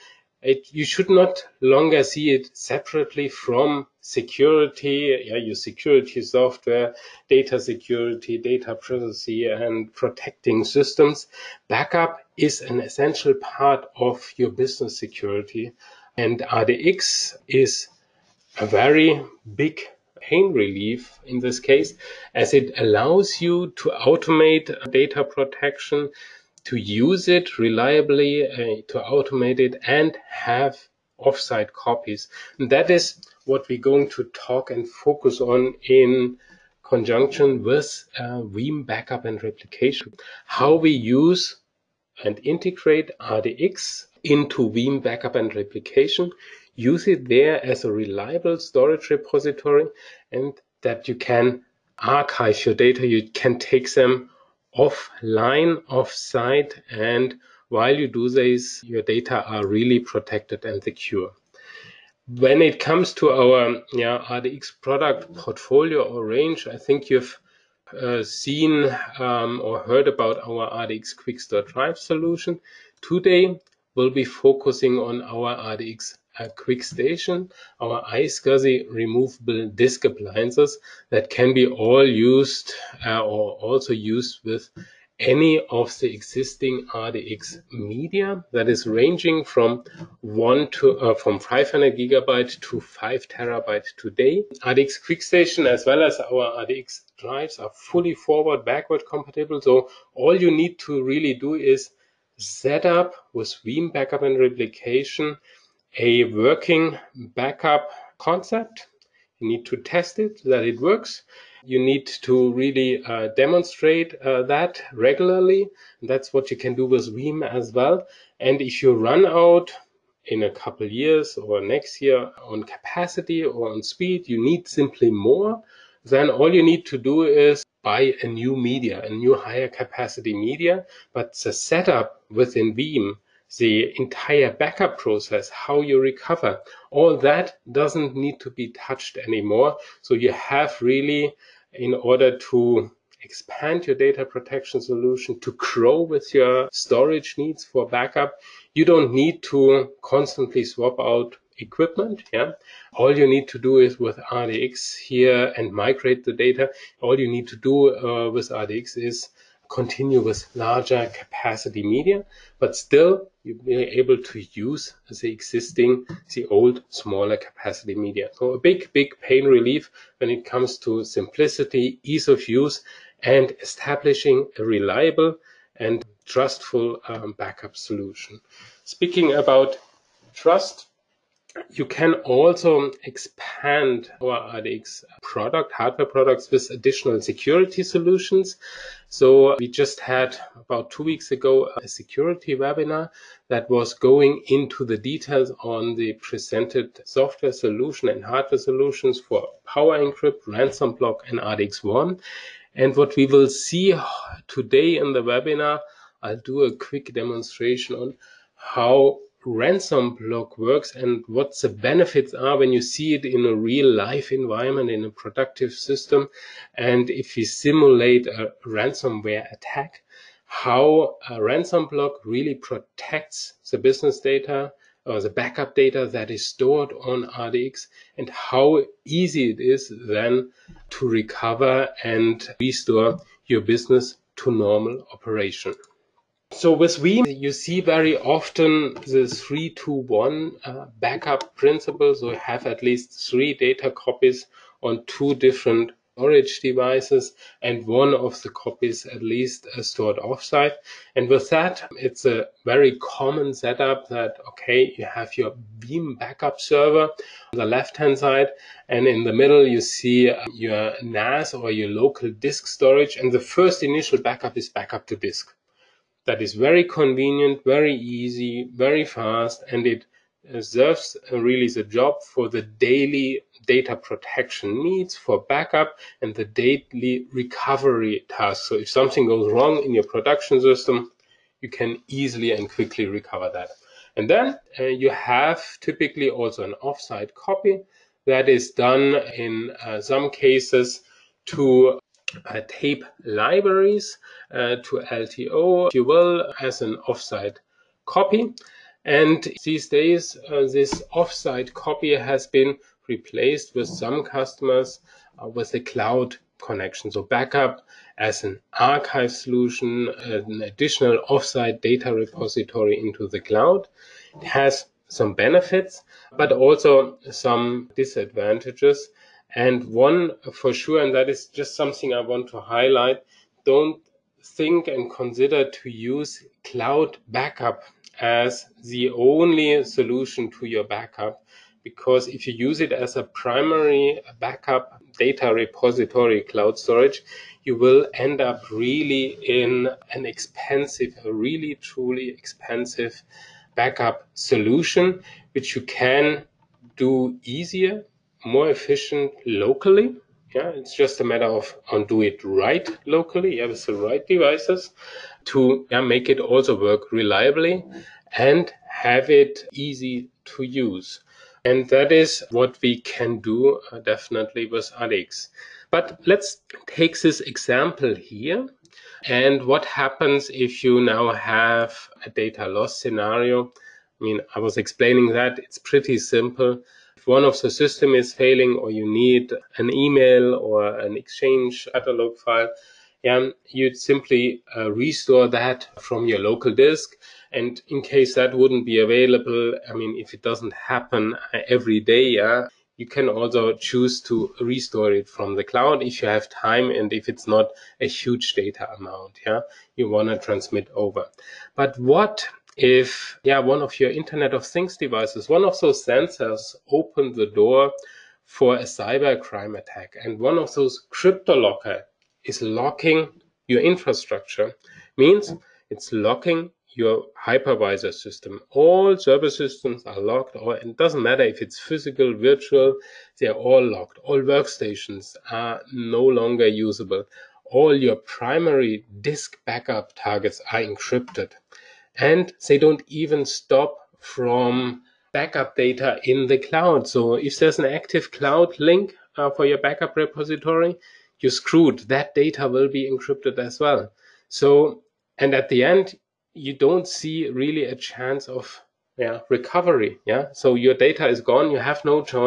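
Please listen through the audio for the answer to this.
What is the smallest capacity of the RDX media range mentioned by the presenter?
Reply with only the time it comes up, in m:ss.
1:31.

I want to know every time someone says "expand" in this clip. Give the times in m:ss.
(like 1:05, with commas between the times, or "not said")
2:23, 3:03.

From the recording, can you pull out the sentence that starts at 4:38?
So if something goes wrong in your production system, you can easily and quickly recover that.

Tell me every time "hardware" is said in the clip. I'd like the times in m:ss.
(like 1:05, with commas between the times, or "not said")
3:05, 3:18.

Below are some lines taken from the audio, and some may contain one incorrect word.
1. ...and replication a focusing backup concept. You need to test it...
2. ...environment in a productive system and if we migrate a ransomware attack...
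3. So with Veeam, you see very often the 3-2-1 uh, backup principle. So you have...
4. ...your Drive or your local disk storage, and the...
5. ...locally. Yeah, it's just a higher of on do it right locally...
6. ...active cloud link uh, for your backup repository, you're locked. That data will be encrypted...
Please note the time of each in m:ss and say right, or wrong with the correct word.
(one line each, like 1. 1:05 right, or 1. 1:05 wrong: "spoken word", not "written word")
1. 1:44 wrong: "working", not "focusing"
2. 3:34 wrong: "simulate", not "migrate"
3. 3:56 right
4. 4:20 wrong: "NAS", not "Drive"
5. 5:49 wrong: "matter", not "higher"
6. 7:17 wrong: "screwed", not "locked".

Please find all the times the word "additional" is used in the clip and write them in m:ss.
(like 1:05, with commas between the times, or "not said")
3:06, 5:10.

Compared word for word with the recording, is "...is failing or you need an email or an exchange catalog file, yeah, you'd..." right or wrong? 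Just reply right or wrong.
right.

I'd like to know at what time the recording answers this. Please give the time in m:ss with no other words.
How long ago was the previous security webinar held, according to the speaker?
3:10.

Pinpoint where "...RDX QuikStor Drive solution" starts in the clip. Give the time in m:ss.
1:10.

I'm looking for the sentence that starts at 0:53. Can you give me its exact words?
You can take them offline, off site, and while you do this, your data are really protected and secure.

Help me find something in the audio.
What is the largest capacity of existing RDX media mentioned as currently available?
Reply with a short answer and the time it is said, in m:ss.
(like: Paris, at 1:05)
5 terabyte, at 1:32.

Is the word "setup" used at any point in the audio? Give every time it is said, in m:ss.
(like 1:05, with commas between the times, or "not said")
2:11, 4:13.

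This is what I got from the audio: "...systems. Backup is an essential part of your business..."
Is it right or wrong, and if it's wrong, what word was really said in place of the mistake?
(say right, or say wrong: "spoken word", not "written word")
right.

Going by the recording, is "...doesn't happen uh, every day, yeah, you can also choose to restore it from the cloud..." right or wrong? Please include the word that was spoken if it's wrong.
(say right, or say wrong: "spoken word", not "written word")
right.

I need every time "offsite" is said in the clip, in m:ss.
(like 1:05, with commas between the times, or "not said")
0:31, 4:10, 4:46, 4:57, 5:01, 5:11.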